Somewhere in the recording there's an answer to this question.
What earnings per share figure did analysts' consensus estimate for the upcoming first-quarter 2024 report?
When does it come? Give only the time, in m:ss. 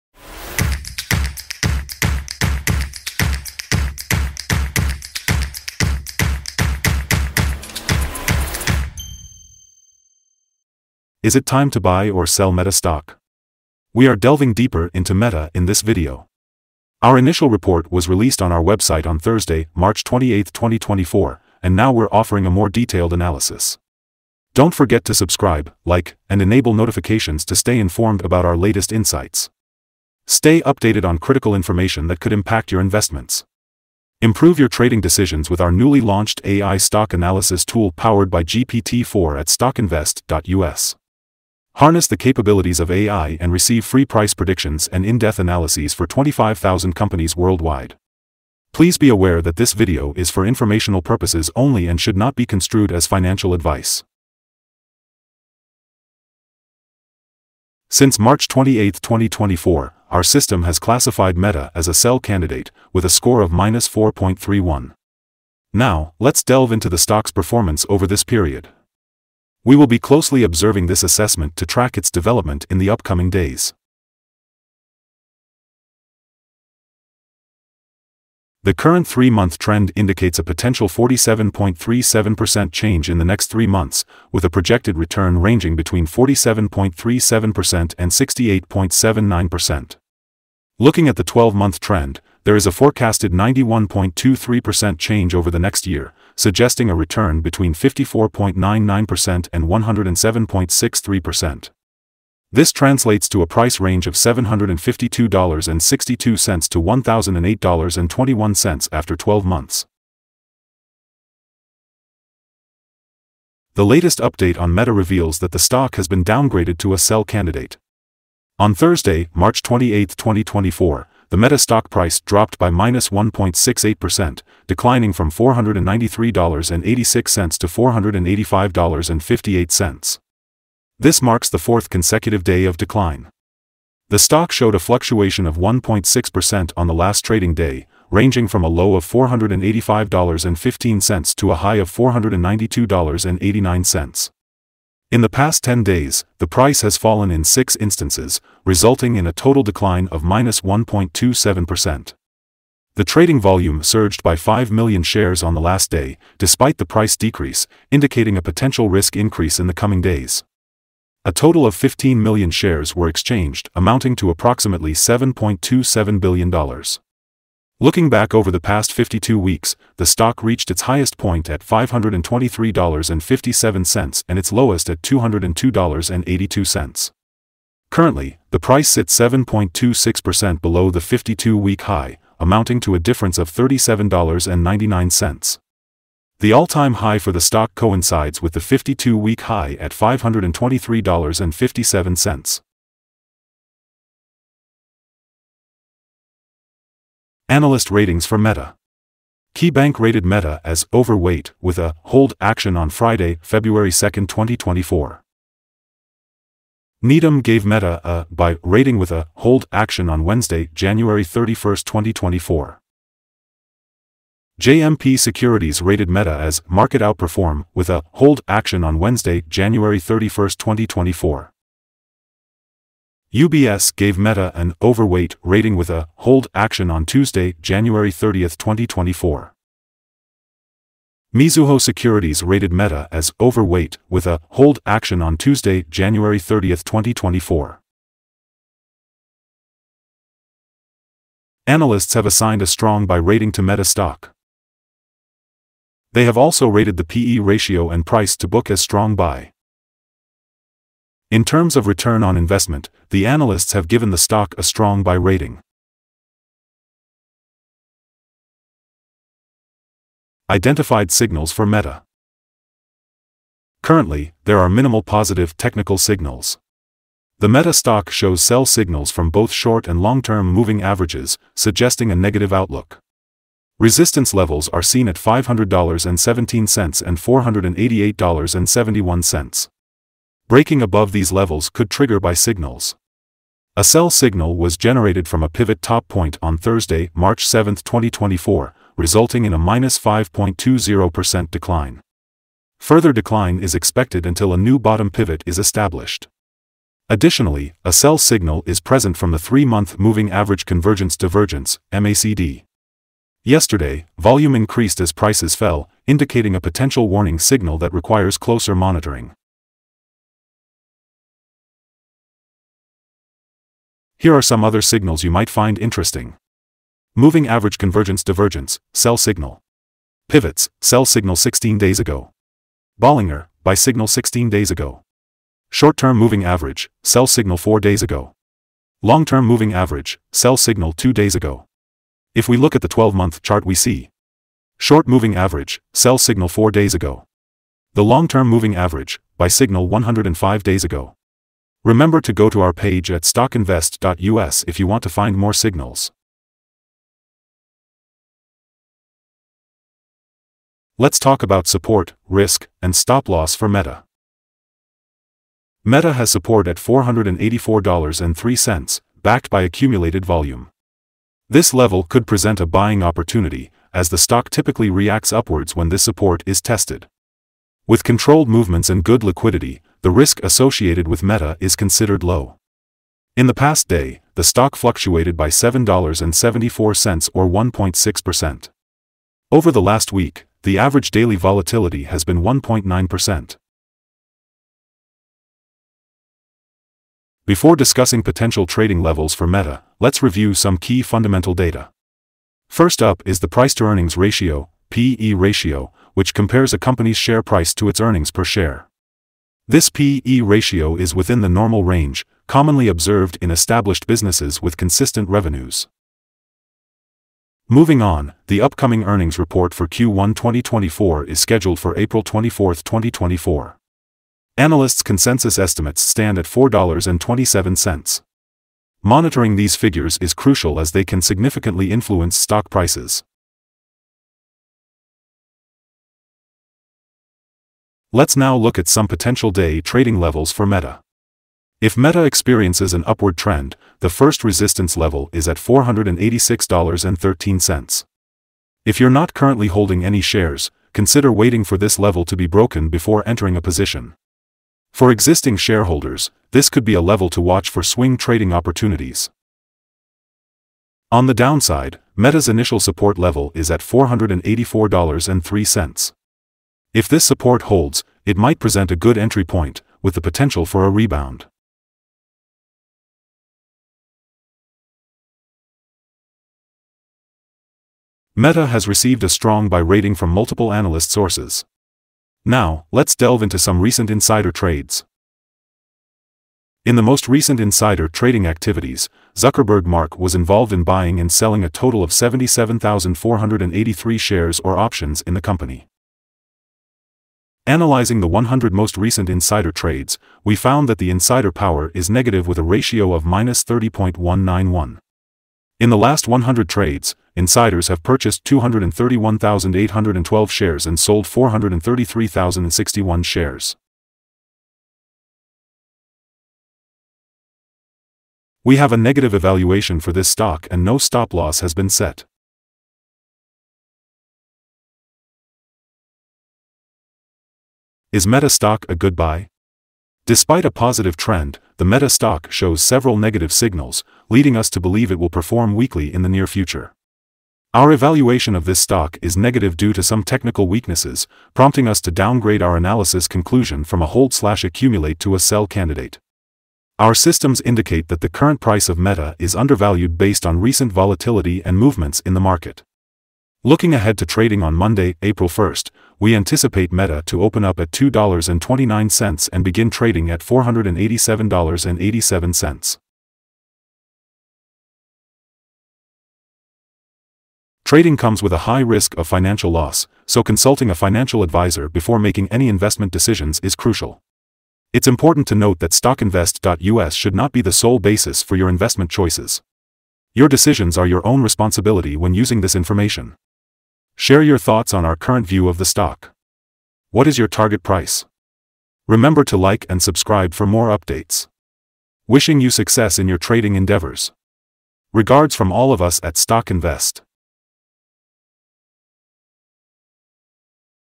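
6:56.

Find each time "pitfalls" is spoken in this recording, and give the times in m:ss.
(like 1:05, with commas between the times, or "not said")
not said.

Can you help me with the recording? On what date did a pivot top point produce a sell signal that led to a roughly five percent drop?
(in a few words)
March 7, 2024.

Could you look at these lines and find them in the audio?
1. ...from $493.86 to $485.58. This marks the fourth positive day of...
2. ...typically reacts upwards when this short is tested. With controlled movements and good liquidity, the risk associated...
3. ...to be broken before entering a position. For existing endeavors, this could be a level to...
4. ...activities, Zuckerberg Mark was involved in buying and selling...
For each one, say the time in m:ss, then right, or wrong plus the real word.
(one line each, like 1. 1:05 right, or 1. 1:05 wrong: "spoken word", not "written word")
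1. 2:05 wrong: "consecutive", not "positive"
2. 6:04 wrong: "support", not "short"
3. 7:22 wrong: "shareholders", not "endeavors"
4. 7:58 right.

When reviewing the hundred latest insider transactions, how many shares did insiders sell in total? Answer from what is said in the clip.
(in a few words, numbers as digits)
433,061.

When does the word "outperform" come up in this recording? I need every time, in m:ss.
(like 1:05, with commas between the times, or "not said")
3:37.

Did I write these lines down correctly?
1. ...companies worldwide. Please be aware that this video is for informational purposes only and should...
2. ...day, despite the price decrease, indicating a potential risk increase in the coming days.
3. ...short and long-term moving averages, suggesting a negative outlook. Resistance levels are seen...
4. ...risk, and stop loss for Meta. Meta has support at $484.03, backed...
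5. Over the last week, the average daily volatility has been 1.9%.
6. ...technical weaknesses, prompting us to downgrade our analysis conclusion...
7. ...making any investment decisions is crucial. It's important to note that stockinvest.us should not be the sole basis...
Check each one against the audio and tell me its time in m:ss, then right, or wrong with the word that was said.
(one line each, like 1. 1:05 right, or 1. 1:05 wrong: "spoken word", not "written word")
1. 0:46 right
2. 2:35 right
3. 4:29 right
4. 5:52 right
5. 6:19 right
6. 8:50 right
7. 9:22 right.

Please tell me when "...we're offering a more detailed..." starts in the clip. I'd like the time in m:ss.
0:21.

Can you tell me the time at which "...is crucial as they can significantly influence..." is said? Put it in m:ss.
7:00.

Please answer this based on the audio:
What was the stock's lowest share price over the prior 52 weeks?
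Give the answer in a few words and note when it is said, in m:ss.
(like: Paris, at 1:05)
$202.82, at 2:55.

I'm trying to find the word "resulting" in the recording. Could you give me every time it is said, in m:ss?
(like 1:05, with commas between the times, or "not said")
2:28, 4:48.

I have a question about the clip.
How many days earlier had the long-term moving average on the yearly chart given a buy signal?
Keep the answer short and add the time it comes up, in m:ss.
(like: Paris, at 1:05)
105, at 5:39.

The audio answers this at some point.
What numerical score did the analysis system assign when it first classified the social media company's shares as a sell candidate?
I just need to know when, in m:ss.
1:03.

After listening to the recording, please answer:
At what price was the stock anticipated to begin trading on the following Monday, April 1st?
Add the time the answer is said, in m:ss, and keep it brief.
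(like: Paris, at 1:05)
$487.87, at 9:10.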